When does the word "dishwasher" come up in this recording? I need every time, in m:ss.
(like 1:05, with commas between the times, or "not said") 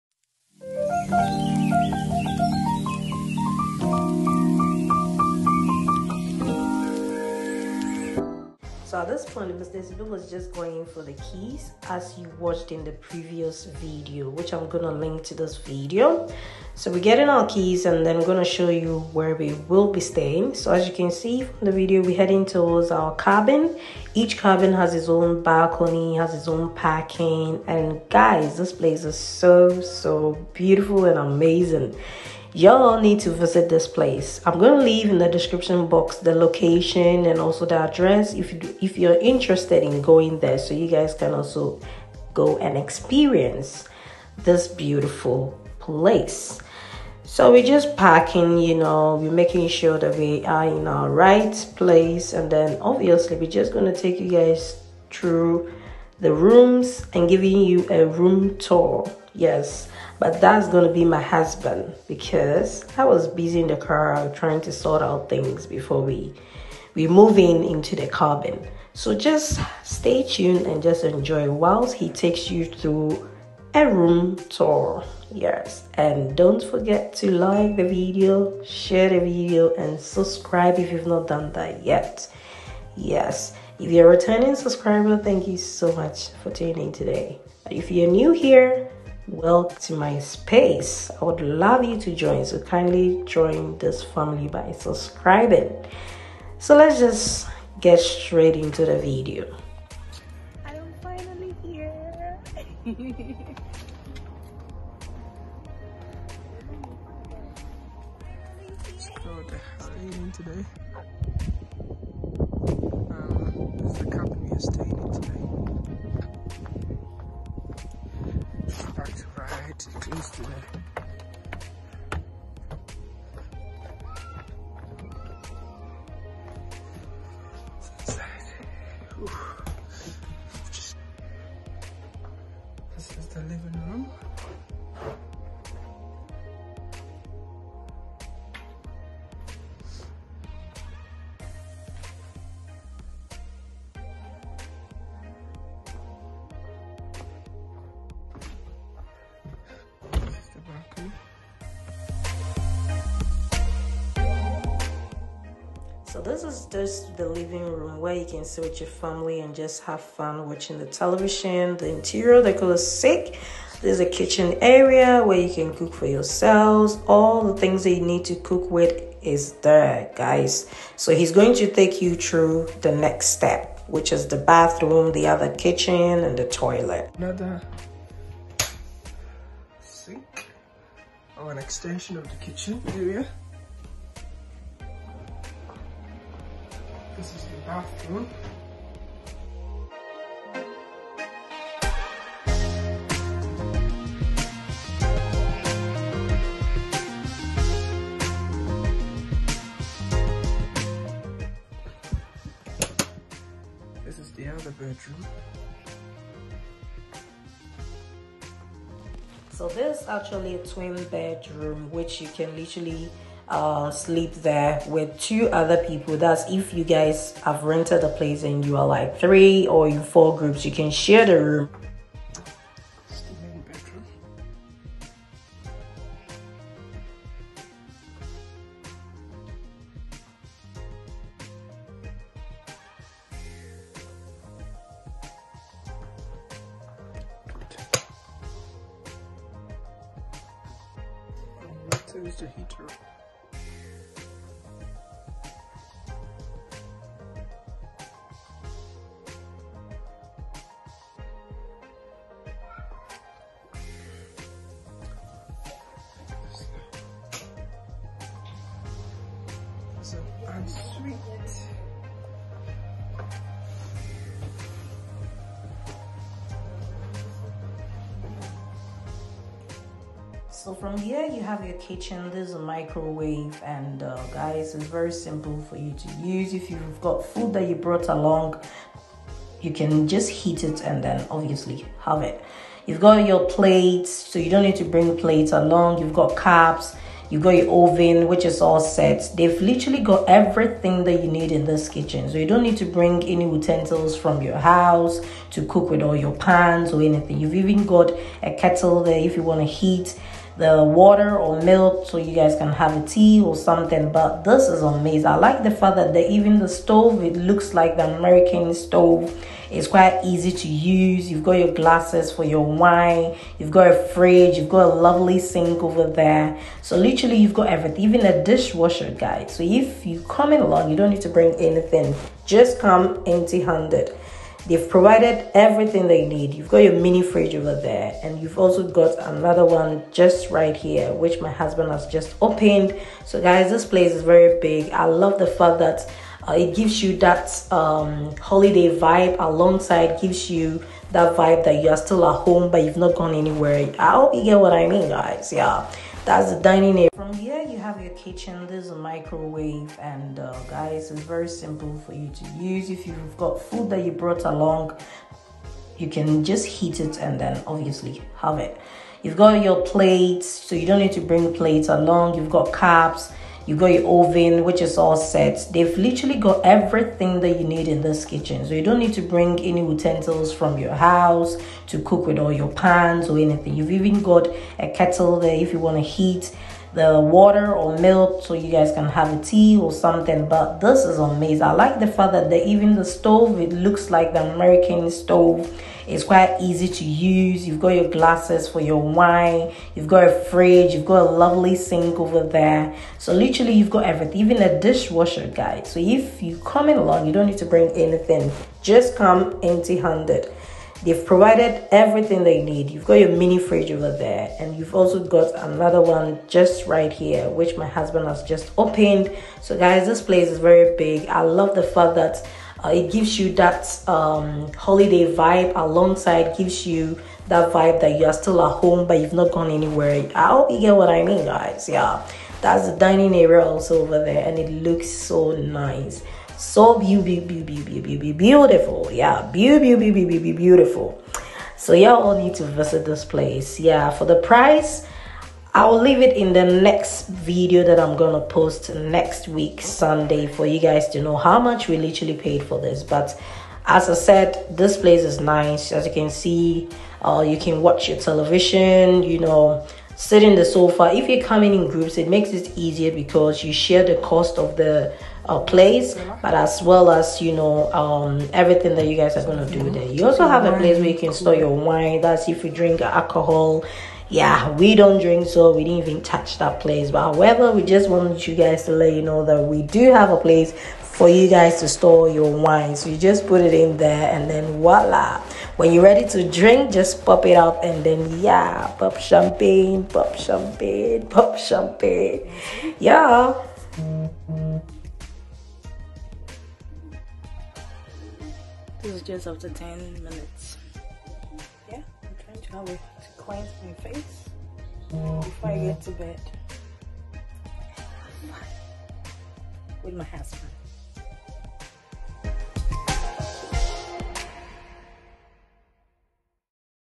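5:18, 6:34.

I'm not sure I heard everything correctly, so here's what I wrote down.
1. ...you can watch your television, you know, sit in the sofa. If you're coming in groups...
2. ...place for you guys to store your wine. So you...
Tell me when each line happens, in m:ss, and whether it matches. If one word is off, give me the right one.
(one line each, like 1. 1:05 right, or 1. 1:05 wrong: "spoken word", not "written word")
1. 7:27 right
2. 7:50 right.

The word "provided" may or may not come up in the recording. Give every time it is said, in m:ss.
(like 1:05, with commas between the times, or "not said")
5:24, 6:41.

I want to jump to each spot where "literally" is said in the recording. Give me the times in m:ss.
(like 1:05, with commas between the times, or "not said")
3:32, 4:49, 5:16, 6:05, 6:33, 7:21.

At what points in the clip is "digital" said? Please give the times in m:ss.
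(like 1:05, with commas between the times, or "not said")
not said.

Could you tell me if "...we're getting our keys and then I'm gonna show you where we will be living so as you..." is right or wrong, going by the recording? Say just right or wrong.
wrong.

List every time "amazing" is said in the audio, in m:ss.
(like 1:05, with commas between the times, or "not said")
0:31, 5:04, 6:21.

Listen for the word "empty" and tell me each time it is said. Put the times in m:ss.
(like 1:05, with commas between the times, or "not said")
5:23, 6:39.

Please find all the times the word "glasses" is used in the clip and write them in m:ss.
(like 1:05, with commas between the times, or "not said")
5:11, 6:28.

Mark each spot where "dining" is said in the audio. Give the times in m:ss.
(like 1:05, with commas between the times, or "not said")
5:46, 7:02.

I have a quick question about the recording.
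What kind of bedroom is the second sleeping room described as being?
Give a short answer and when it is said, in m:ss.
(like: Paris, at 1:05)
A twin bedroom, at 3:30.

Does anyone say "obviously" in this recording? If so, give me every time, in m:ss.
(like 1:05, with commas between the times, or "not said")
0:52, 4:41, 5:57.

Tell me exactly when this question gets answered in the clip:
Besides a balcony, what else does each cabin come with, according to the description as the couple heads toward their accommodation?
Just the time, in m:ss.
0:26.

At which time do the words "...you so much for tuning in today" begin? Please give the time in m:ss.
1:25.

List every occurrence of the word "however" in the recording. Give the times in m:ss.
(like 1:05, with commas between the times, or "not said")
7:47.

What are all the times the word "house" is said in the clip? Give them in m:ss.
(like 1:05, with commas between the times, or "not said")
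4:54, 6:10.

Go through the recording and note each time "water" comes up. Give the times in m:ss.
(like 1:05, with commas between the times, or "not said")
5:00, 6:17.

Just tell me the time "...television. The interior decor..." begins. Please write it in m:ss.
2:40.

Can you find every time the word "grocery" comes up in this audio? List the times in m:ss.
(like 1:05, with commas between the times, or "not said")
not said.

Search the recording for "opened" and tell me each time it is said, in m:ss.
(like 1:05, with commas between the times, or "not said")
5:32, 6:48.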